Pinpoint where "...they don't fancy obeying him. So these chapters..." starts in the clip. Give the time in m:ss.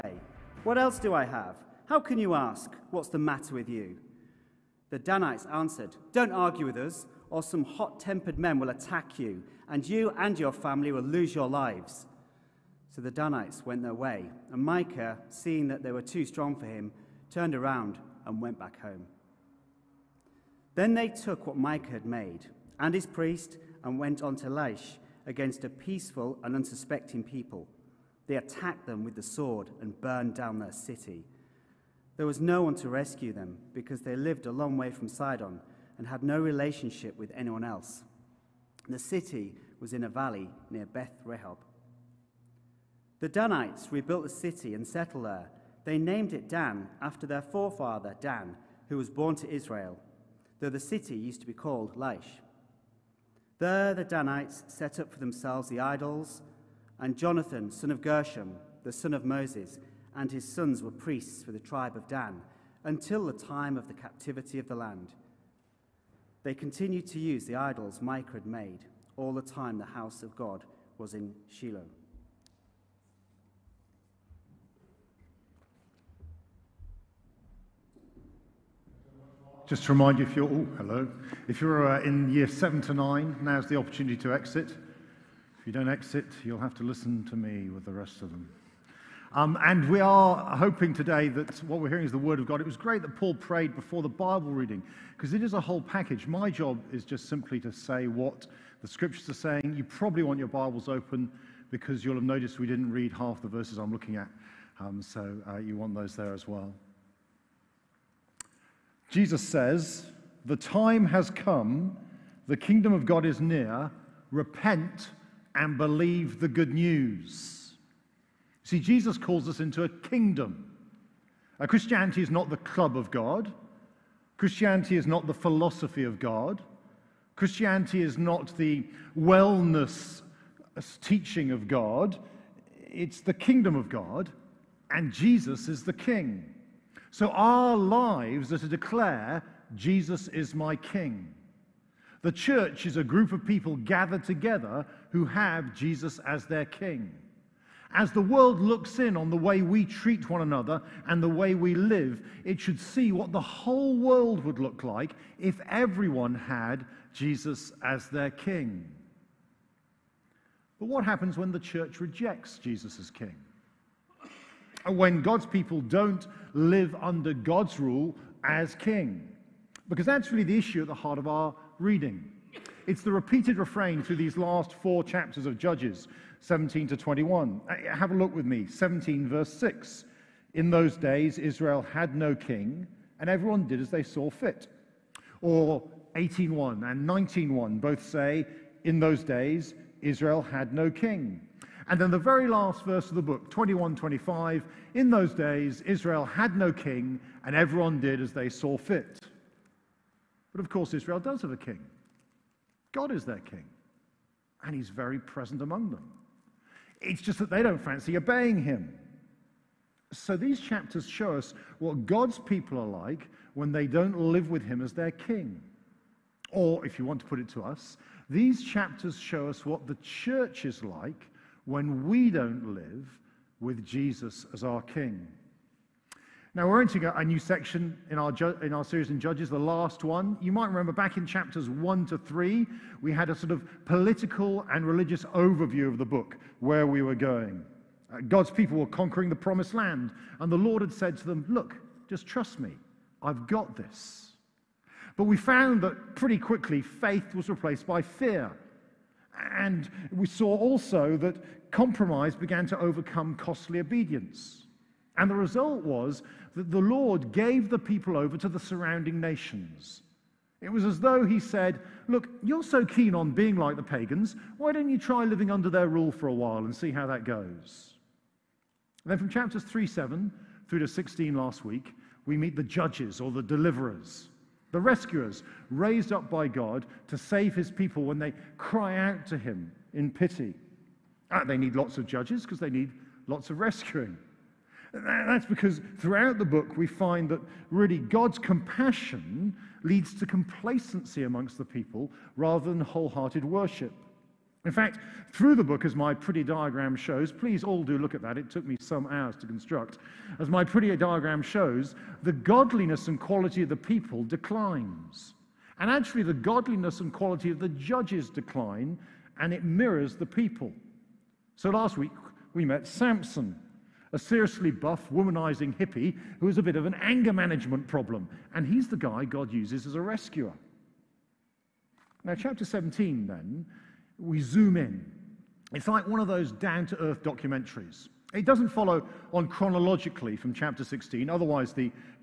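3:27.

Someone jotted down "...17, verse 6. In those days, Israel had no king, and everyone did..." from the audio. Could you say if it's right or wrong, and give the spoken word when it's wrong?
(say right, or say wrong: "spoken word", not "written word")
right.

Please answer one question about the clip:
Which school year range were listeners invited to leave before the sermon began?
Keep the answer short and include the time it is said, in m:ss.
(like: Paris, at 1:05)
Year 7 to 9, at 1:22.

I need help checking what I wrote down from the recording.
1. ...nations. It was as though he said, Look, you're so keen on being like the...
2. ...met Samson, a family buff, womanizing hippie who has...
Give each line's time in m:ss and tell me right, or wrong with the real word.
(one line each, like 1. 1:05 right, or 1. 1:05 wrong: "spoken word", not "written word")
1. 4:19 right
2. 5:12 wrong: "seriously", not "family".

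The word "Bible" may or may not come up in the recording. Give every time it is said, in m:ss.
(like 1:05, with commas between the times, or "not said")
1:34, 1:40.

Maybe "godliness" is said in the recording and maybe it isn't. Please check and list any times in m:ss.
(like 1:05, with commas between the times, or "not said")
5:02, 5:06.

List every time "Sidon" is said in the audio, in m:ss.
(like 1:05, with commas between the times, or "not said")
0:35.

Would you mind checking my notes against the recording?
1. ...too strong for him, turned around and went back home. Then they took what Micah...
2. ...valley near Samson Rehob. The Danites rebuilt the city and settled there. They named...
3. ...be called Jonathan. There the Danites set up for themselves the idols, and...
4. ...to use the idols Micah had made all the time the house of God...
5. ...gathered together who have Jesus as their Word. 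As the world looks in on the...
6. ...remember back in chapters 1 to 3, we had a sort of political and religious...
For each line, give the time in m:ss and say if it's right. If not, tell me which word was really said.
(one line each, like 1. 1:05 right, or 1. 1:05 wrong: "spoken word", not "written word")
1. 0:16 right
2. 0:40 wrong: "Beth", not "Samson"
3. 0:51 wrong: "Laish", not "Jonathan"
4. 1:07 right
5. 2:23 wrong: "King", not "Word"
6. 3:50 right.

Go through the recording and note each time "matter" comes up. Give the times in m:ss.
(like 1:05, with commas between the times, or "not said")
0:03.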